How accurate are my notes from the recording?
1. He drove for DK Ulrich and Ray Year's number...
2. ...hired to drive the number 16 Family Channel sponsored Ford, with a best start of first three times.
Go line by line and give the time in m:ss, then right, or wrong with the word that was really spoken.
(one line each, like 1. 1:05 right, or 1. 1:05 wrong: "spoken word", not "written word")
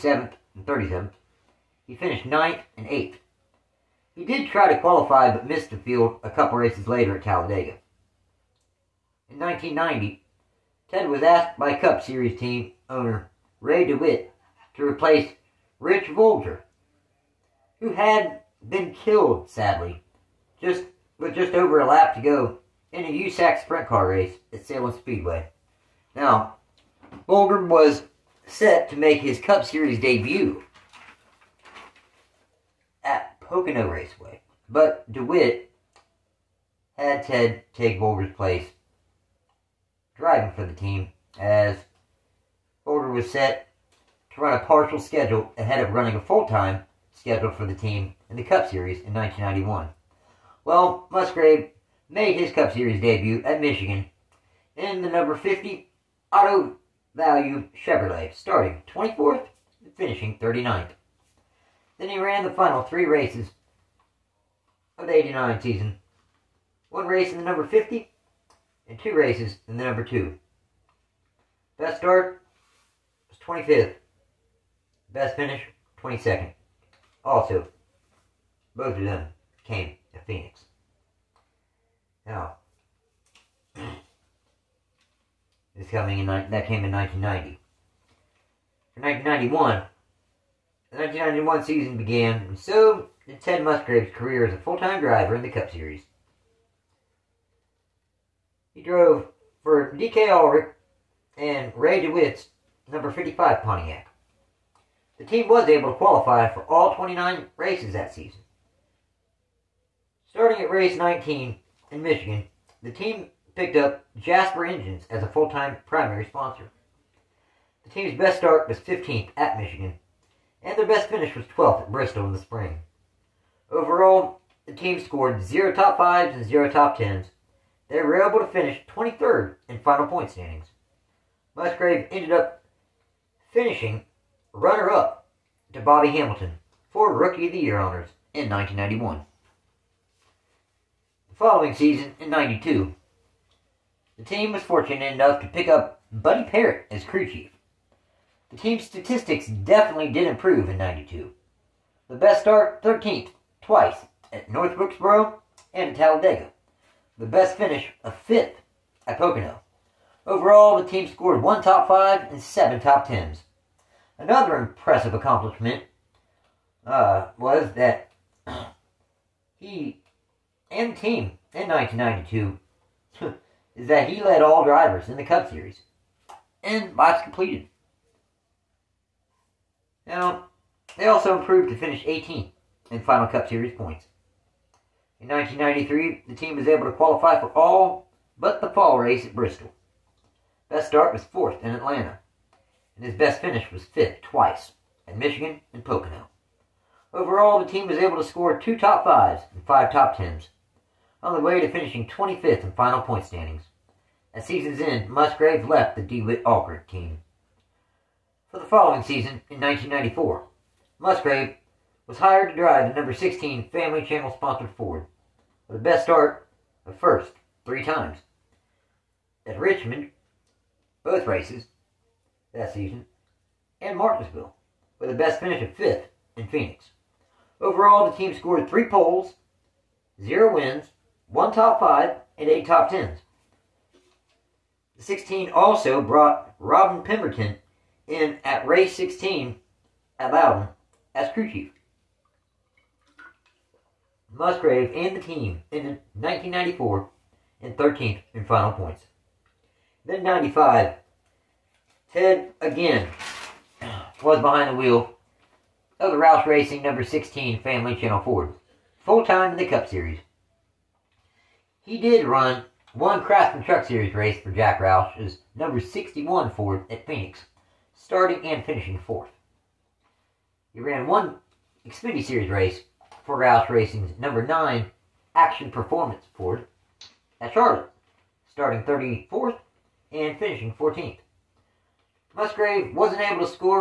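1. 1:38 wrong: "DeWitt", not "Year"
2. 3:32 right.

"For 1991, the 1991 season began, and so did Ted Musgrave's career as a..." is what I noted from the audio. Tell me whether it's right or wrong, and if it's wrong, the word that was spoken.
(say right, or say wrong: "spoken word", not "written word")
right.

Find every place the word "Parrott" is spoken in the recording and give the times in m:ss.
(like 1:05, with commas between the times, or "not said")
2:26.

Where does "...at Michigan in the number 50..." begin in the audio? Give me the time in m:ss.
0:53.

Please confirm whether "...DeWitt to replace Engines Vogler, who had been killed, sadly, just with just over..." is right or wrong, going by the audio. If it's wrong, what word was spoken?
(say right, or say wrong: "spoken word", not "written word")
wrong: "Rich", not "Engines".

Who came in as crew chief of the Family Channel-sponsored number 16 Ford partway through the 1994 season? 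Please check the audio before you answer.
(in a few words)
Robin Pemberton.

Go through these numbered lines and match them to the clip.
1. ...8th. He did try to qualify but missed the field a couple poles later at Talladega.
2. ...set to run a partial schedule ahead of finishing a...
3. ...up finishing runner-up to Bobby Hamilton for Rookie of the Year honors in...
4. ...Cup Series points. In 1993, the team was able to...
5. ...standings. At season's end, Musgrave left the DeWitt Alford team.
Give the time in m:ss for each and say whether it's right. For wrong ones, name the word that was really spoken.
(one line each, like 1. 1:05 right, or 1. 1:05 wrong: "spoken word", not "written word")
1. 0:02 wrong: "races", not "poles"
2. 0:43 wrong: "running", not "finishing"
3. 2:12 right
4. 3:03 right
5. 3:23 right.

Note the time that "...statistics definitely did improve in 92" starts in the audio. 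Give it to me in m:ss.
2:28.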